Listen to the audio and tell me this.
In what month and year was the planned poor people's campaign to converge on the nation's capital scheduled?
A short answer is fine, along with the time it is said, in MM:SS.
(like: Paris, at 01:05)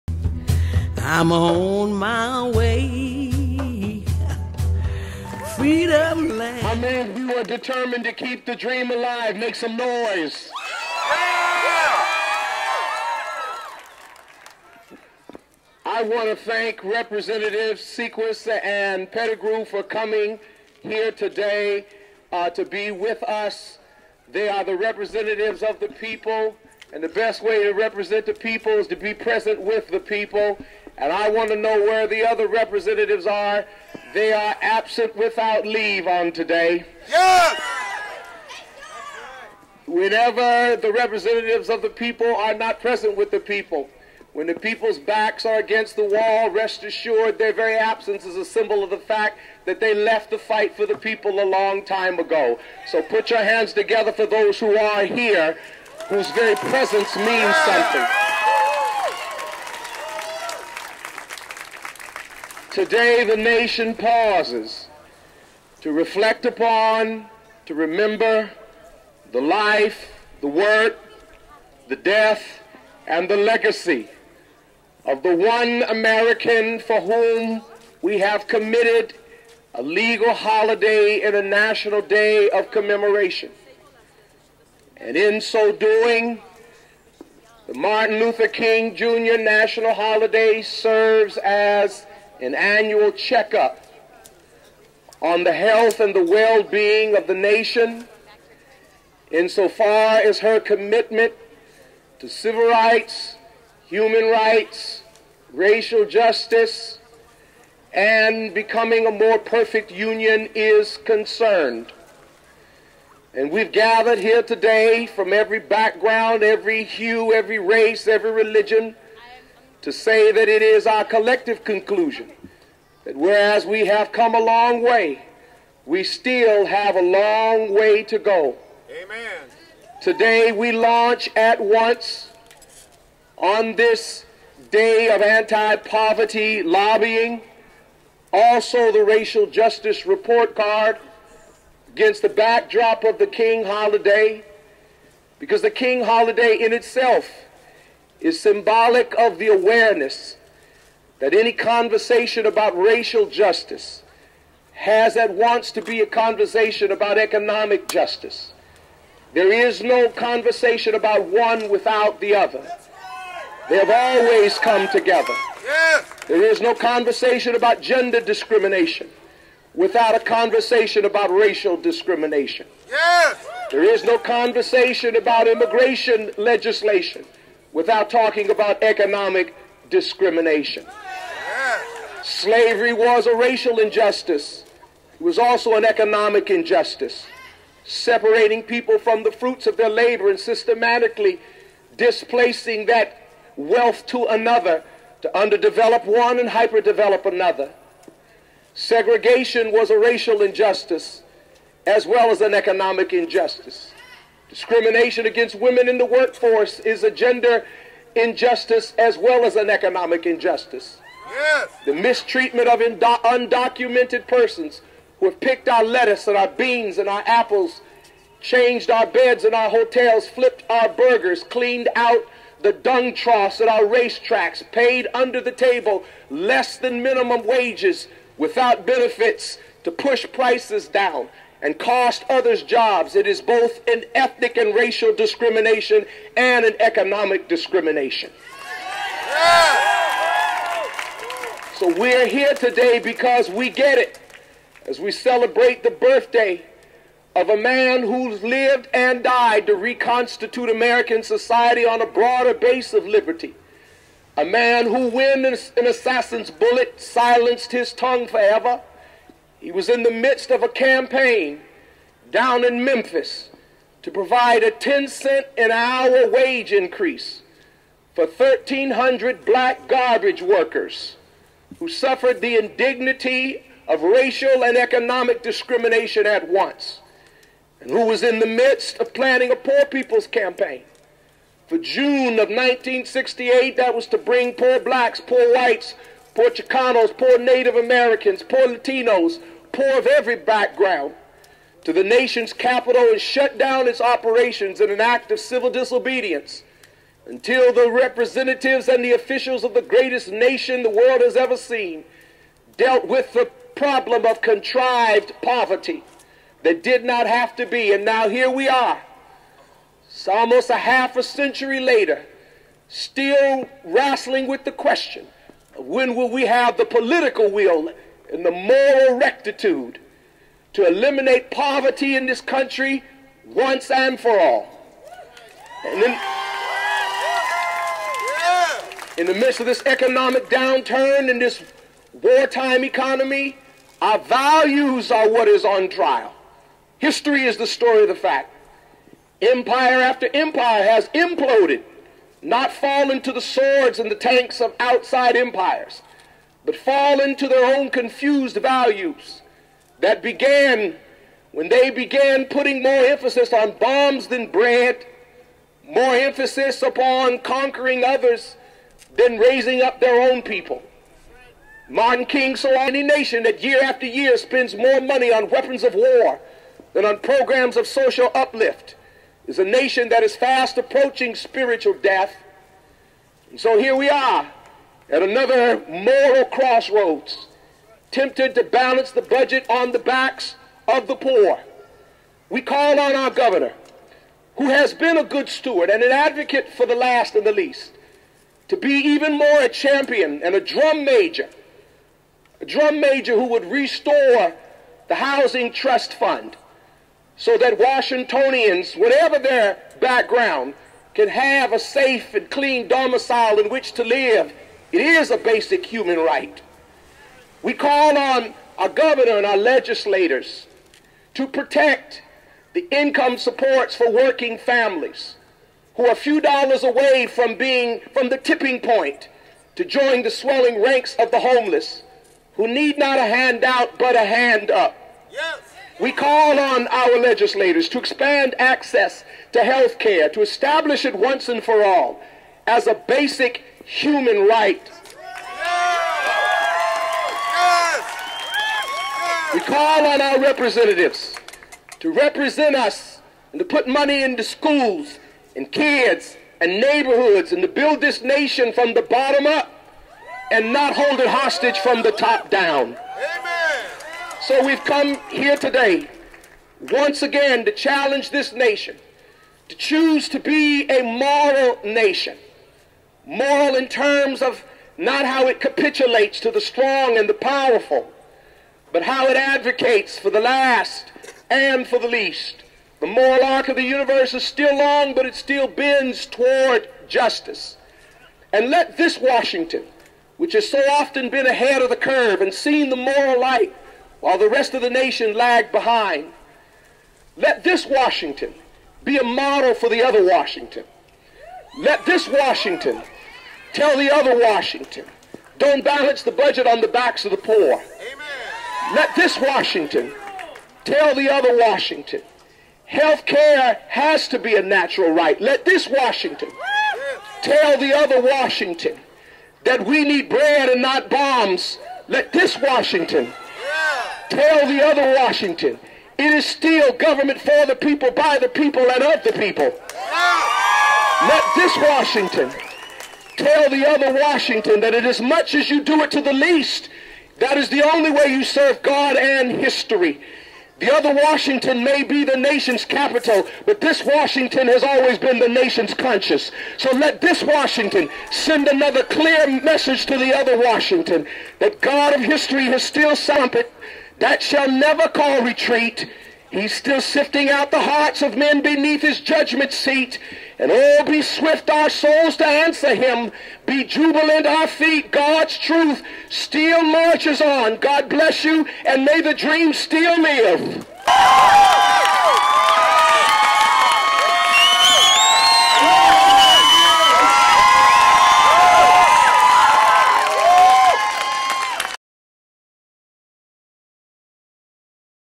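June 1968, at 04:41.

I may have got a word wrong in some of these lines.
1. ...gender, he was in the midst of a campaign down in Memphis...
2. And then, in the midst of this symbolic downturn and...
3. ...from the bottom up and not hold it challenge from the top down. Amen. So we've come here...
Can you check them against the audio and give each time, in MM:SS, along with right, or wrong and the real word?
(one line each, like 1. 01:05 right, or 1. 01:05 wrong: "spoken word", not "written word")
1. 04:18 wrong: "forever", not "gender"
2. 05:25 wrong: "economic", not "symbolic"
3. 07:28 wrong: "hostage", not "challenge".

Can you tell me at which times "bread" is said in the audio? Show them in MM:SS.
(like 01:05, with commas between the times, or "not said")
05:54, 08:30.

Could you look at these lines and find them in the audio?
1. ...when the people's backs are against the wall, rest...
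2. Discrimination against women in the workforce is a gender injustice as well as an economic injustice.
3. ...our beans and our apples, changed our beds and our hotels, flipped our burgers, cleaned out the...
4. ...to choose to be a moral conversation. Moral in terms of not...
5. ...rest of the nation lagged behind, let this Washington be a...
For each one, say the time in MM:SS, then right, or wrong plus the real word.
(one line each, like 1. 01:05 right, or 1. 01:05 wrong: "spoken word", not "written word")
1. 00:44 right
2. 03:24 right
3. 03:36 right
4. 07:39 wrong: "nation", not "conversation"
5. 08:04 right.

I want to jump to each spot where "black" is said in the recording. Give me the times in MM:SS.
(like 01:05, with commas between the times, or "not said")
04:29, 04:44.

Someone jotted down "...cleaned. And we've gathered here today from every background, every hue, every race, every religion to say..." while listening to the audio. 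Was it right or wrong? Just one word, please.
wrong.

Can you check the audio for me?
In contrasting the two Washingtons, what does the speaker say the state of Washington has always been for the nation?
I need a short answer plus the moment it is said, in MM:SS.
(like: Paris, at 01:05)
the nation's conscience, at 08:55.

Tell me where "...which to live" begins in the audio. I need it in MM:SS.
06:43.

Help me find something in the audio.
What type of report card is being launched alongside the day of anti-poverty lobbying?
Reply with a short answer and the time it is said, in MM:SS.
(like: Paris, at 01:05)
racial justice report card, at 02:19.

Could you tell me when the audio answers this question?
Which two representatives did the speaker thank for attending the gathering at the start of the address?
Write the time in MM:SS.
00:17.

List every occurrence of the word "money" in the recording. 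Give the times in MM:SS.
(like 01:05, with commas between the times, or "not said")
06:05, 07:23.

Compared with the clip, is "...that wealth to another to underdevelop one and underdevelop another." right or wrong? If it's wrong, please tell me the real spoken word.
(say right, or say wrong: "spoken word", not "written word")
wrong: "hyperdevelop", not "underdevelop".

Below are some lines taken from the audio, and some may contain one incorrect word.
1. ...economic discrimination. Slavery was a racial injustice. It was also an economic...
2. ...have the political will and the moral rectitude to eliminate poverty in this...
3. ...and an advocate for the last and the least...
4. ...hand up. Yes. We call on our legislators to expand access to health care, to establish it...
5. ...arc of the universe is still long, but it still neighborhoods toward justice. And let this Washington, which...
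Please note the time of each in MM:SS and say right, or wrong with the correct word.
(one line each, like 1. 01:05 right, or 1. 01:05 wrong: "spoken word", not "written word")
1. 02:58 right
2. 05:16 right
3. 06:25 right
4. 07:04 right
5. 07:53 wrong: "bends", not "neighborhoods".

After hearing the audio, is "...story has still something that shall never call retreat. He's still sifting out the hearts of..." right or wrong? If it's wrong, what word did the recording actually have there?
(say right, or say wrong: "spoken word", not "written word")
wrong: "history", not "story".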